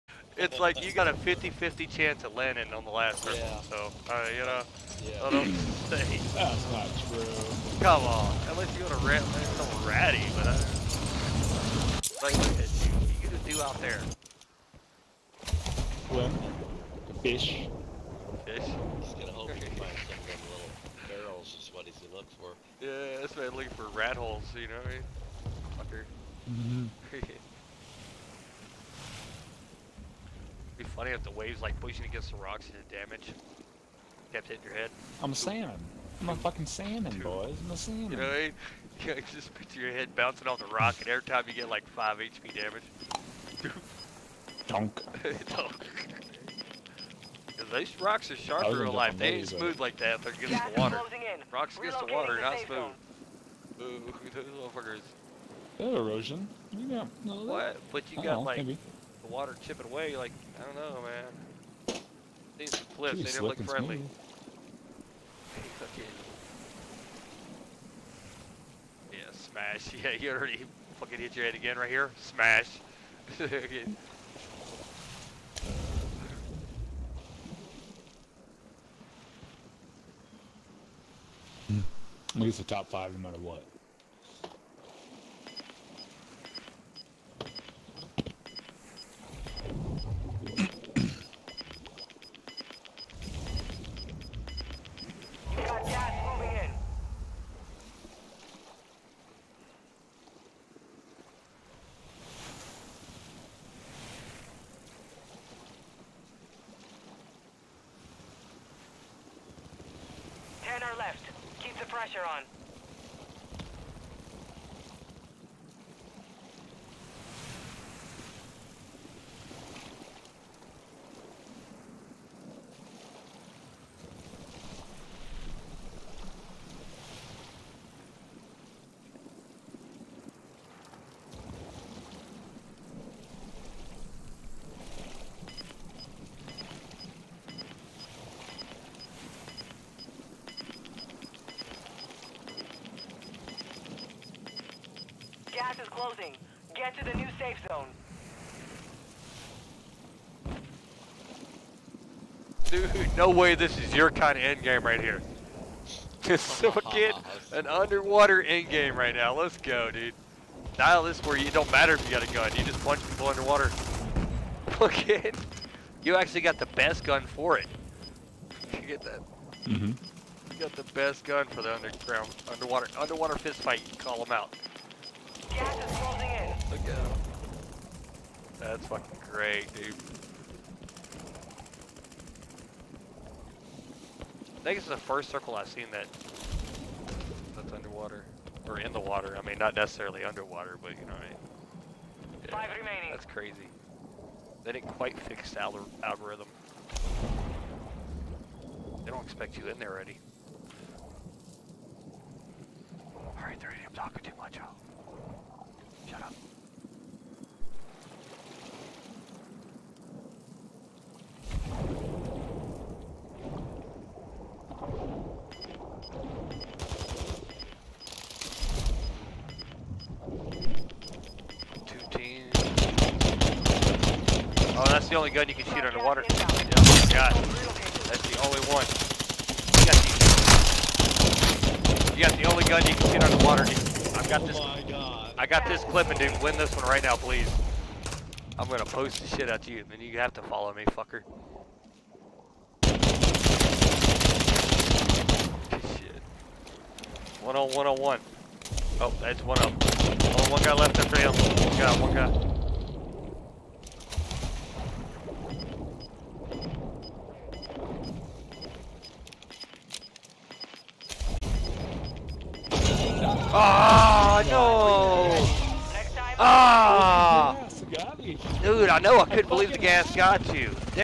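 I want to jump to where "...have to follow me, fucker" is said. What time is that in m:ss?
4:00.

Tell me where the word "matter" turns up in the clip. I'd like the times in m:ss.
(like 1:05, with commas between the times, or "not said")
1:23, 2:41.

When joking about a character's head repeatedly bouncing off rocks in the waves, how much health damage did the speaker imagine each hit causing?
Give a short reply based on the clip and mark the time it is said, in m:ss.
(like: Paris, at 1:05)
5 HP, at 0:41.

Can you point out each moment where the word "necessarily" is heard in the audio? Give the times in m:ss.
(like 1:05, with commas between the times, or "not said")
3:09.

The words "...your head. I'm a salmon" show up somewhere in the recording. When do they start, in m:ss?
0:34.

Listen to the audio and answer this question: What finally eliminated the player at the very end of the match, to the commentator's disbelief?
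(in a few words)
The gas.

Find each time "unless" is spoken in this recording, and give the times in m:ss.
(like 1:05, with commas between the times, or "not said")
0:08.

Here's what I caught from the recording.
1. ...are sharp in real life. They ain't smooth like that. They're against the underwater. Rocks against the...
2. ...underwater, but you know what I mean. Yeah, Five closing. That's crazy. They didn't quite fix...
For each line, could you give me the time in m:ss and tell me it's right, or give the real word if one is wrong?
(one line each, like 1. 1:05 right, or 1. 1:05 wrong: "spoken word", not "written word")
1. 0:48 wrong: "water", not "underwater"
2. 3:10 wrong: "remaining", not "closing".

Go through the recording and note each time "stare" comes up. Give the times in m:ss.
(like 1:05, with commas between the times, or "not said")
not said.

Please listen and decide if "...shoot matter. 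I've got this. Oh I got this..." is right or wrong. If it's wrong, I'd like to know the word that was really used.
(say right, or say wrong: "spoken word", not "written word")
wrong: "underwater", not "matter".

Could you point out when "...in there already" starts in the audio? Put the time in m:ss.
3:19.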